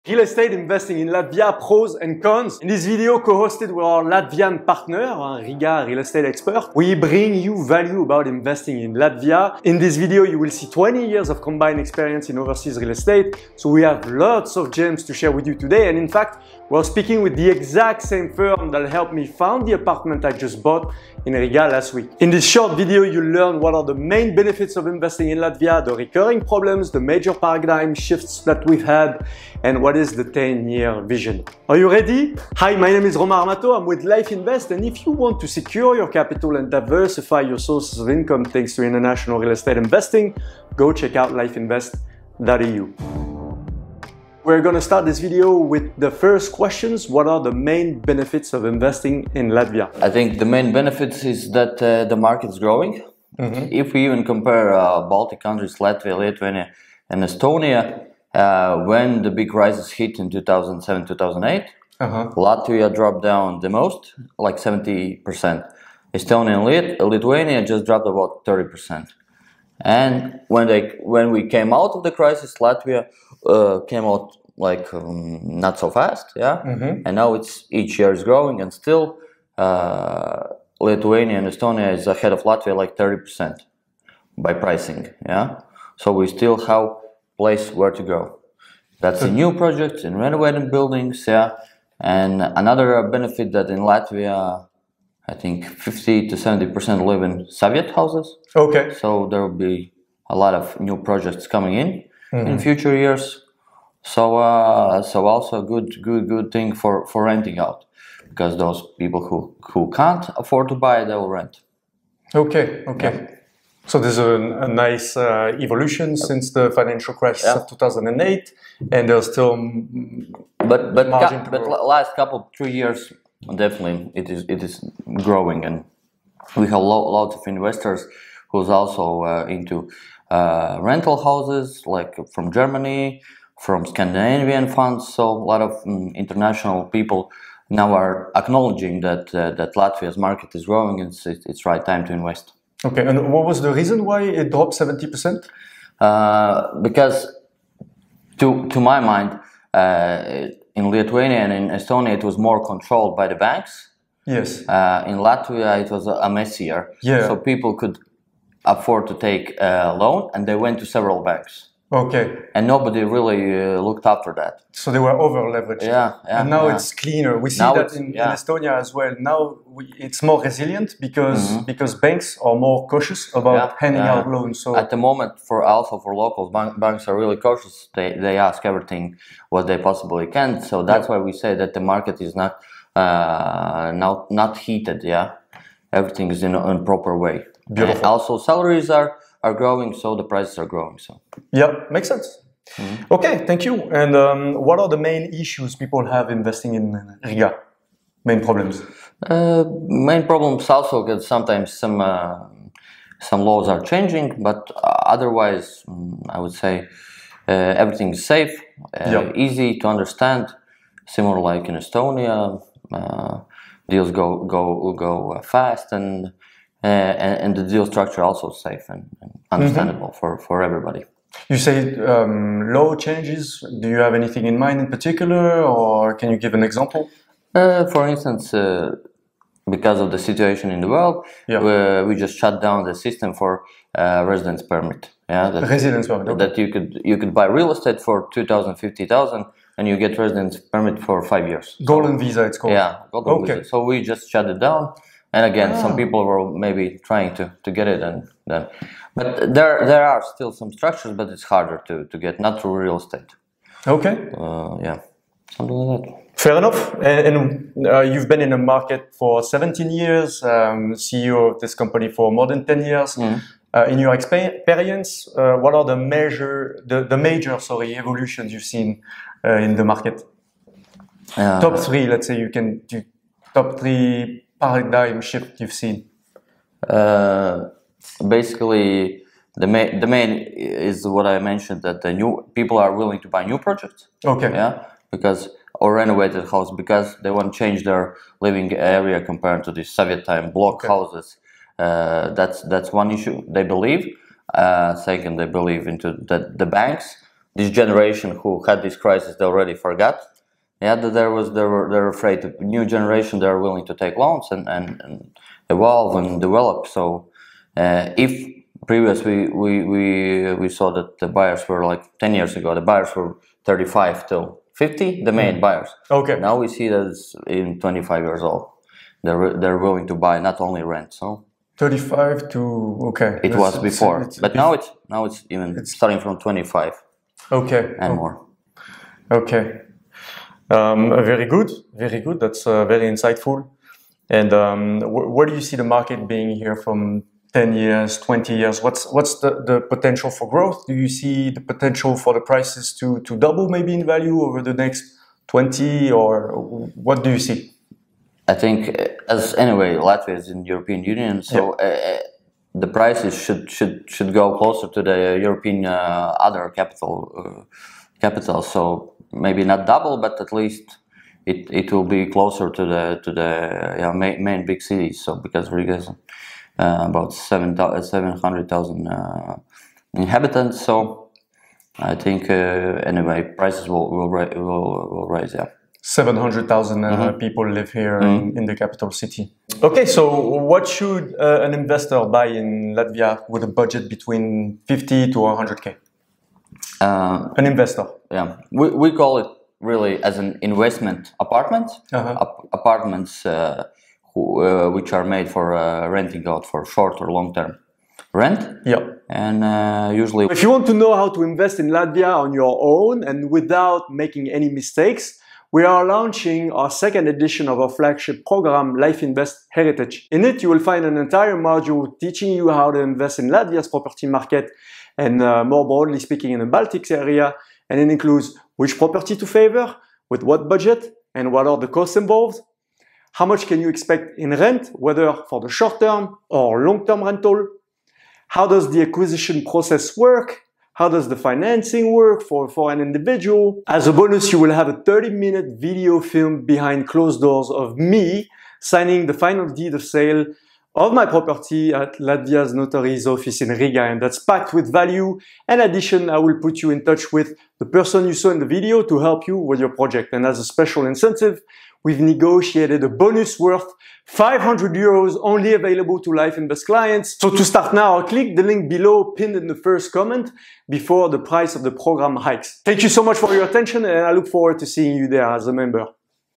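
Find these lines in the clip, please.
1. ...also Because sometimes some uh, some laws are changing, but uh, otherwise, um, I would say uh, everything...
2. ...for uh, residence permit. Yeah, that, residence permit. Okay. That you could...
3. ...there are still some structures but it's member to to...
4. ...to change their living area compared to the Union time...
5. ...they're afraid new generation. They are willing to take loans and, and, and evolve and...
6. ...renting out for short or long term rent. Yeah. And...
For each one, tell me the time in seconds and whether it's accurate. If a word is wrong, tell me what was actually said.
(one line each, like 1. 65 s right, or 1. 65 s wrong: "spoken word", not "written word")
1. 200 s right
2. 233 s right
3. 249 s wrong: "harder", not "member"
4. 287 s wrong: "Soviet", not "Union"
5. 301 s right
6. 396 s right.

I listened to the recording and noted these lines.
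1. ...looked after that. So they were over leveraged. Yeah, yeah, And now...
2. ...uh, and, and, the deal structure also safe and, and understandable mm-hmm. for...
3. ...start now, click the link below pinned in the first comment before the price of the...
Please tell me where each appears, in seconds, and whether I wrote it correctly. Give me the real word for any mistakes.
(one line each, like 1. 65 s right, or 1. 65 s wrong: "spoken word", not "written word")
1. 163 s right
2. 216 s right
3. 457 s right.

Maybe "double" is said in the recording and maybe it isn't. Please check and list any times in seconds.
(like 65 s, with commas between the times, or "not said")
343 s, 359 s.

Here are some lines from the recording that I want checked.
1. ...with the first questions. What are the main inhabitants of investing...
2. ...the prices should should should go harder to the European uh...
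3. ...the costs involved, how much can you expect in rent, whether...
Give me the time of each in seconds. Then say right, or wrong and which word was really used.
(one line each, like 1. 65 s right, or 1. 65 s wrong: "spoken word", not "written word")
1. 45 s wrong: "benefits", not "inhabitants"
2. 352 s wrong: "closer", not "harder"
3. 421 s right.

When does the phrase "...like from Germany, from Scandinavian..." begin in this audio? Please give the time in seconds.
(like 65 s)
131 s.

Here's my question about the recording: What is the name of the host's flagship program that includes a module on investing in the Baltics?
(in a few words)
Life Invest Heritage.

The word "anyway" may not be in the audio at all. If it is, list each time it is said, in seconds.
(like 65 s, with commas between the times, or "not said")
349 s, 373 s.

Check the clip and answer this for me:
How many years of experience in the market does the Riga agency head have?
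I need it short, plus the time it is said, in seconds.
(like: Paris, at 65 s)
17 years, at 259 s.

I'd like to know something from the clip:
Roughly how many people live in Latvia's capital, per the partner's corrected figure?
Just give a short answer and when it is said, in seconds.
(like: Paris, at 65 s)
700,000, at 376 s.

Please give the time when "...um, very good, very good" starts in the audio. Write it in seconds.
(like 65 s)
330 s.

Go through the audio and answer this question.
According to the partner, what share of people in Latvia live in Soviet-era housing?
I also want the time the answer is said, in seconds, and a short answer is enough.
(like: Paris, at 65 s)
50 to 70%, at 95 s.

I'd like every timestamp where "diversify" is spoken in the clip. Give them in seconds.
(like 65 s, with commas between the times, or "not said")
36 s.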